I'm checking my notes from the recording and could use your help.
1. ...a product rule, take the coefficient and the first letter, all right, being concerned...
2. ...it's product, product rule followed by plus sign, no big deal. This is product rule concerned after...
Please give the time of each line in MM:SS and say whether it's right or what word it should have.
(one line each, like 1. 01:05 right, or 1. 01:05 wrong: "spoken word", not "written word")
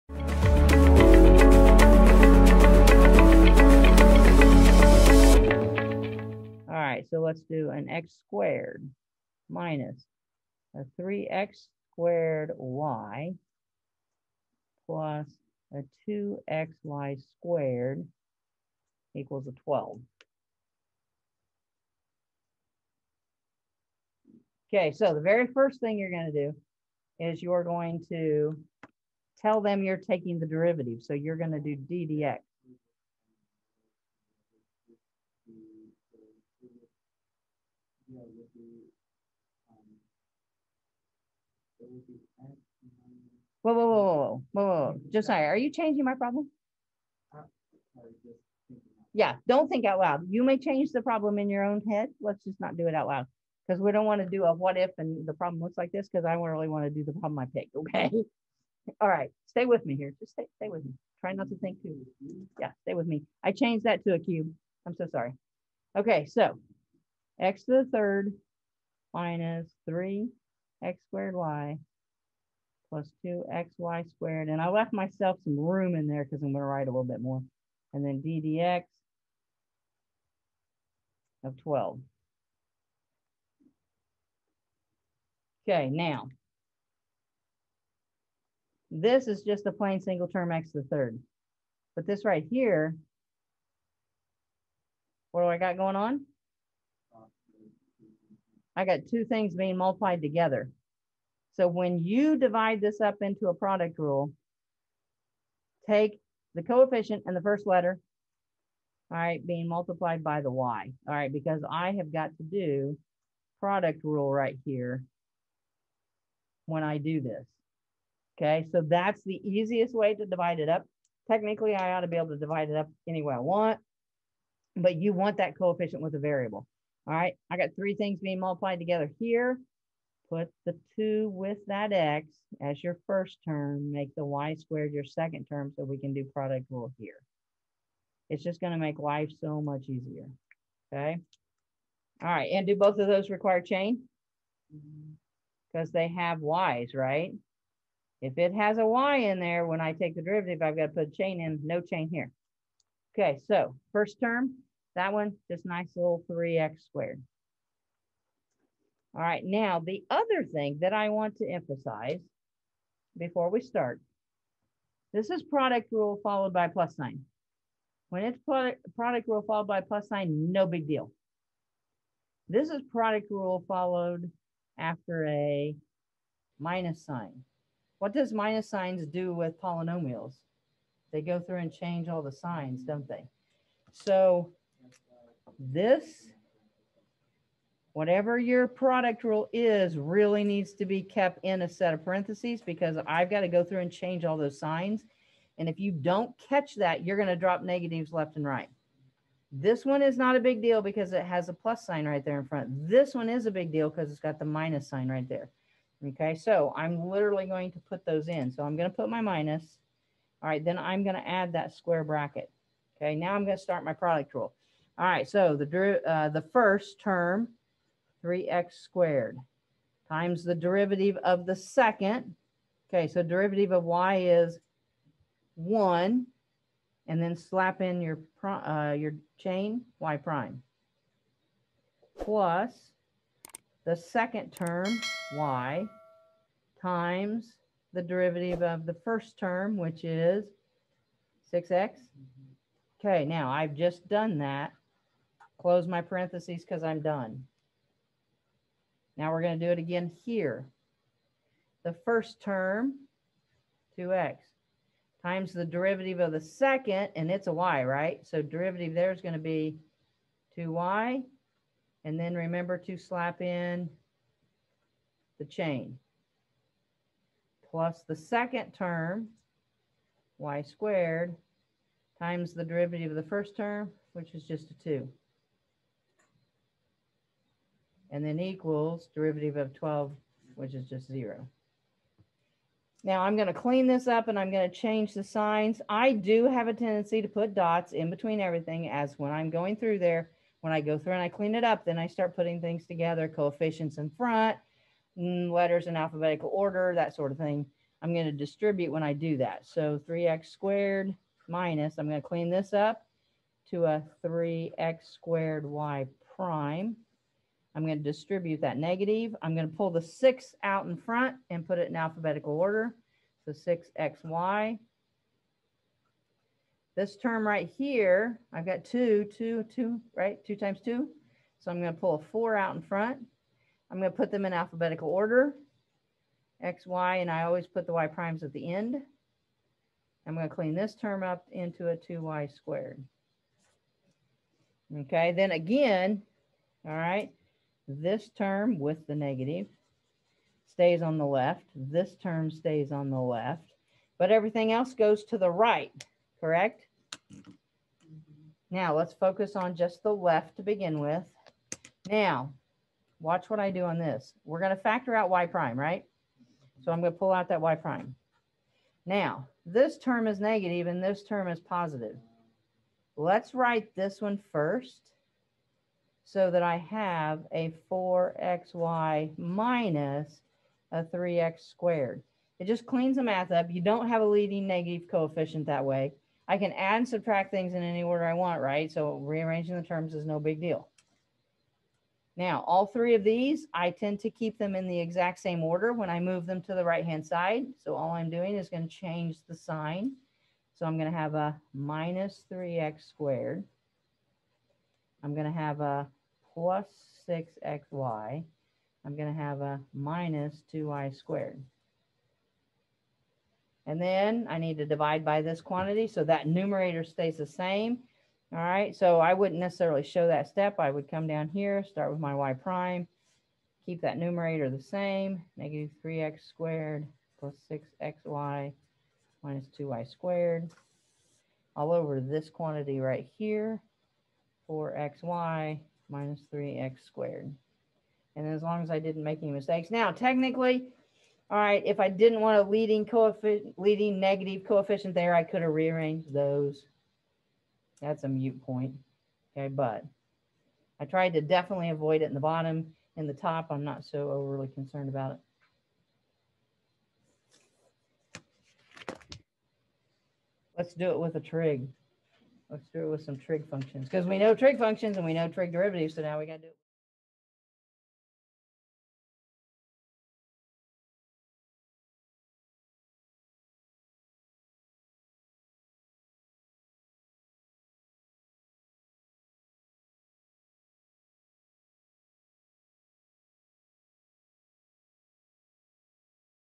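1. 01:43 wrong: "multiplied", not "concerned"
2. 02:48 wrong: "followed", not "concerned".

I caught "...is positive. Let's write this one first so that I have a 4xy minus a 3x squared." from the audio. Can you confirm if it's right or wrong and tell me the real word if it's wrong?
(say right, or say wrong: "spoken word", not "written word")
right.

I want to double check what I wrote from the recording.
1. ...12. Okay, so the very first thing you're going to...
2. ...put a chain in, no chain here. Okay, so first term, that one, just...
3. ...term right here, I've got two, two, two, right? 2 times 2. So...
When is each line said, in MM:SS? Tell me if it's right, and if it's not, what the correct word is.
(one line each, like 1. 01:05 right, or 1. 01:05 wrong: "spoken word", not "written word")
1. 00:19 right
2. 02:30 right
3. 05:17 right.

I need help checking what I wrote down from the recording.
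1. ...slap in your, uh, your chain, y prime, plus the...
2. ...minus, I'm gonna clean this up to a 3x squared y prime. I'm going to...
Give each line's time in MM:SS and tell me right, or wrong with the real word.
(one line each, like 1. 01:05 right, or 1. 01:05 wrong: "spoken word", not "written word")
1. 03:47 right
2. 05:01 right.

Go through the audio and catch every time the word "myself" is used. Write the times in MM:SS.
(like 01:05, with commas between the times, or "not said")
01:14.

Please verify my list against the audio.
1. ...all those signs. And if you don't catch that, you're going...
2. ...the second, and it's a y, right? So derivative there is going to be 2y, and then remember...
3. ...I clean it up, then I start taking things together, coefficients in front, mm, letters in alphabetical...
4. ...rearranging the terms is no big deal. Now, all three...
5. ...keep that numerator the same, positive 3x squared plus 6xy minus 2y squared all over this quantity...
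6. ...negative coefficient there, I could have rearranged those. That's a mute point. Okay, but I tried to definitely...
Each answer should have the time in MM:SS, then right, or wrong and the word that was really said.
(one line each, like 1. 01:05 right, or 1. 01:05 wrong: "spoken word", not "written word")
1. 03:14 right
2. 04:16 right
3. 04:51 wrong: "putting", not "taking"
4. 06:19 right
5. 06:53 wrong: "negative", not "positive"
6. 07:14 right.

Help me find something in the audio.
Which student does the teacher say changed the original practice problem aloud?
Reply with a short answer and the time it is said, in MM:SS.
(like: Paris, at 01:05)
Josiah, at 00:45.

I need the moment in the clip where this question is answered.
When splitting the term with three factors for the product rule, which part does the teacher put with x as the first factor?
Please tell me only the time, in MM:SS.
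02:10.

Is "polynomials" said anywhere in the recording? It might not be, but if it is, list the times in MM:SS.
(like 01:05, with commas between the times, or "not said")
02:59.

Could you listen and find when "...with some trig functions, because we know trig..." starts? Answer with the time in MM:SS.
07:33.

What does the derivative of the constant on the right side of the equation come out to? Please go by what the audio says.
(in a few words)
0.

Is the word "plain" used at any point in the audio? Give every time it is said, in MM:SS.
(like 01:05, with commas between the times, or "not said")
01:29.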